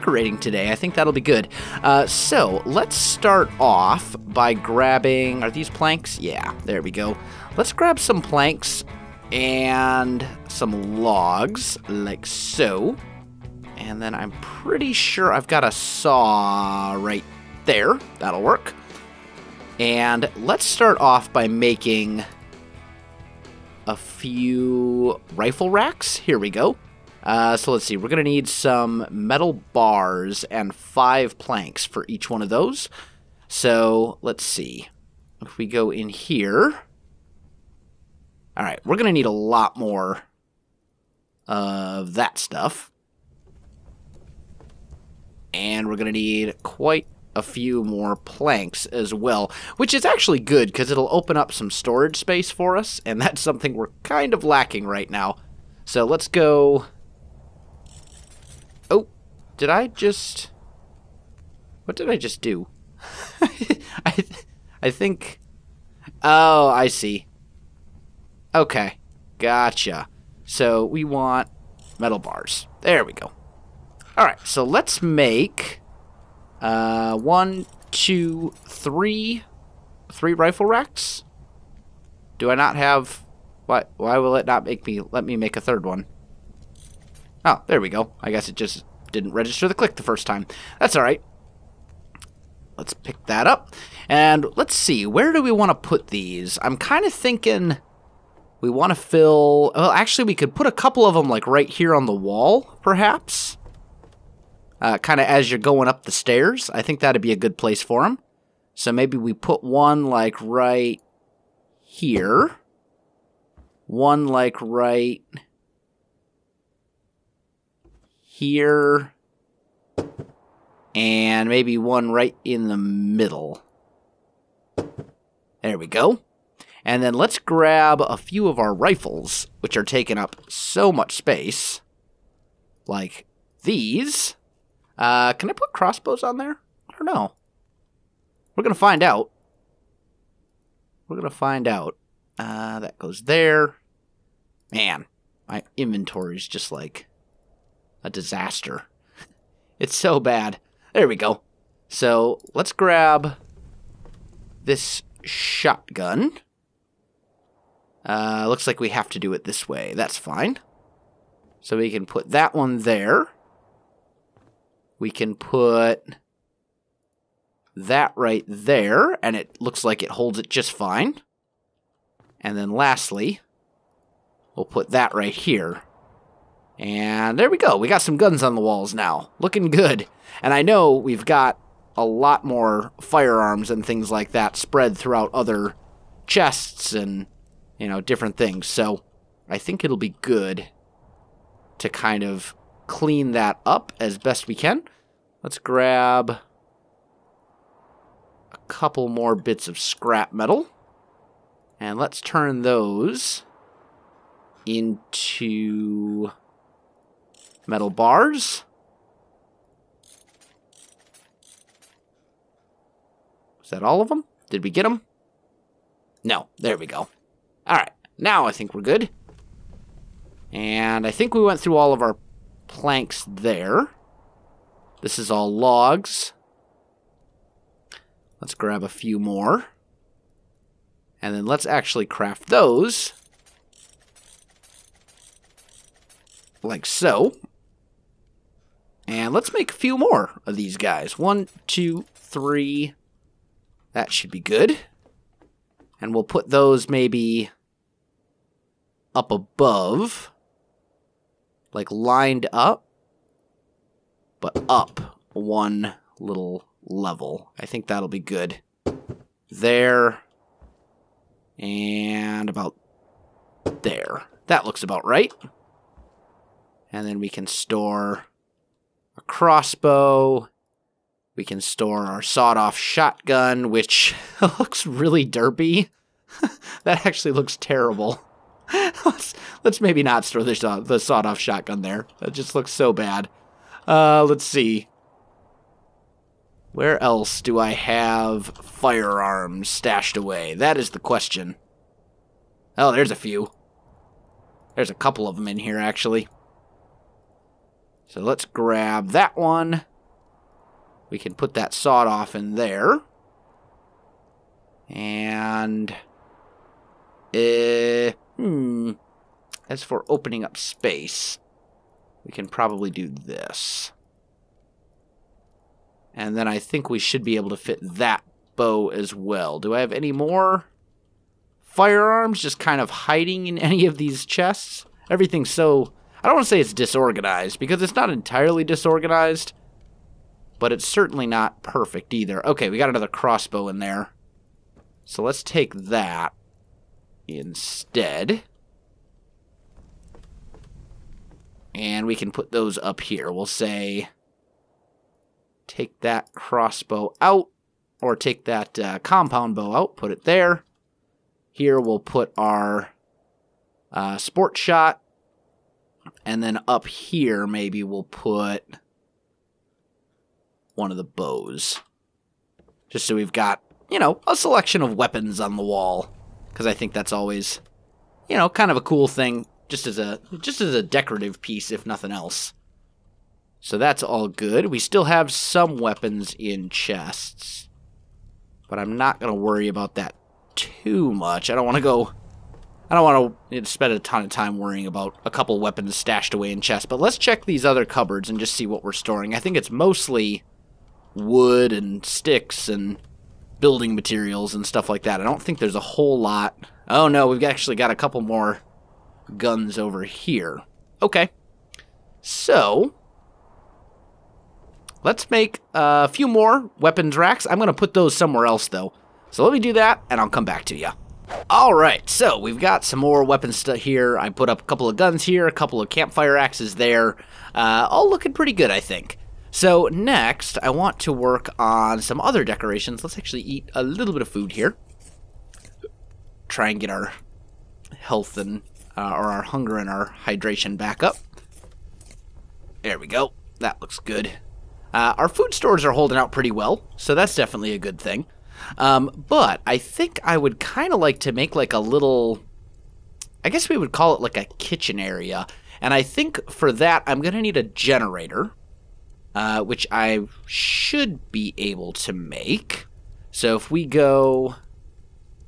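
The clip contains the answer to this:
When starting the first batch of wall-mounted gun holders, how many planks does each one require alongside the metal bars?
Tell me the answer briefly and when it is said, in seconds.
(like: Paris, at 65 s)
5, at 30 s.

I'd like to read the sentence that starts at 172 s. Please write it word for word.
And then lastly, we'll put that right here.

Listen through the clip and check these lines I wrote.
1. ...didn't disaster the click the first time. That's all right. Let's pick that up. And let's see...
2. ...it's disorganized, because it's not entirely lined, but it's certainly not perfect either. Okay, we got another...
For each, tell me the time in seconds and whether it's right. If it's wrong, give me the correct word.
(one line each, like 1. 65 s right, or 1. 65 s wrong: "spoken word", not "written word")
1. 89 s wrong: "register", not "disaster"
2. 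326 s wrong: "disorganized", not "lined".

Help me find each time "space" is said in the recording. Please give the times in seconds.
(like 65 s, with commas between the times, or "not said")
52 s, 131 s, 310 s.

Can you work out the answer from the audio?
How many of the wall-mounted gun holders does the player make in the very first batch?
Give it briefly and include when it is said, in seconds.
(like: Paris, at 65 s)
3, at 80 s.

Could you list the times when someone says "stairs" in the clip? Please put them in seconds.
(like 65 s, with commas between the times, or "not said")
106 s.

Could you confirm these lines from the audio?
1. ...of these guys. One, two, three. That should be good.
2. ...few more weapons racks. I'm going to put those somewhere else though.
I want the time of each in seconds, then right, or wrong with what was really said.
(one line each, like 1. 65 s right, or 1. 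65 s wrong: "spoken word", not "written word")
1. 240 s right
2. 406 s right.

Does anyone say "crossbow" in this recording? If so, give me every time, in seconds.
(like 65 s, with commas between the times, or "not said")
135 s, 269 s, 333 s, 346 s.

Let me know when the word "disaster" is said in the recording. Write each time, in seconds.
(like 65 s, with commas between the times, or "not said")
148 s.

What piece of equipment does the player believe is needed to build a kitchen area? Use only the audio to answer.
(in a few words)
a generator.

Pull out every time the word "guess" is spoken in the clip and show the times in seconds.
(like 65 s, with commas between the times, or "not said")
88 s, 443 s.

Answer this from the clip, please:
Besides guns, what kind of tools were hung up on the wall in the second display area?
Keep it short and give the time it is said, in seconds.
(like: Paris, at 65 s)
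campfire axes, at 415 s.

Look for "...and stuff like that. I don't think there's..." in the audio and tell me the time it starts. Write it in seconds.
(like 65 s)
394 s.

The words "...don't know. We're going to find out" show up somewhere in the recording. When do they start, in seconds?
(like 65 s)
136 s.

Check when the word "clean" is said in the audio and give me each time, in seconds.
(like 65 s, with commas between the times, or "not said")
192 s.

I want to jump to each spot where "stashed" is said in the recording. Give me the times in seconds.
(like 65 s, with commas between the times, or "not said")
289 s, 385 s.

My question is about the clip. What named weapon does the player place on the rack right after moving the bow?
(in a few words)
Sportshot.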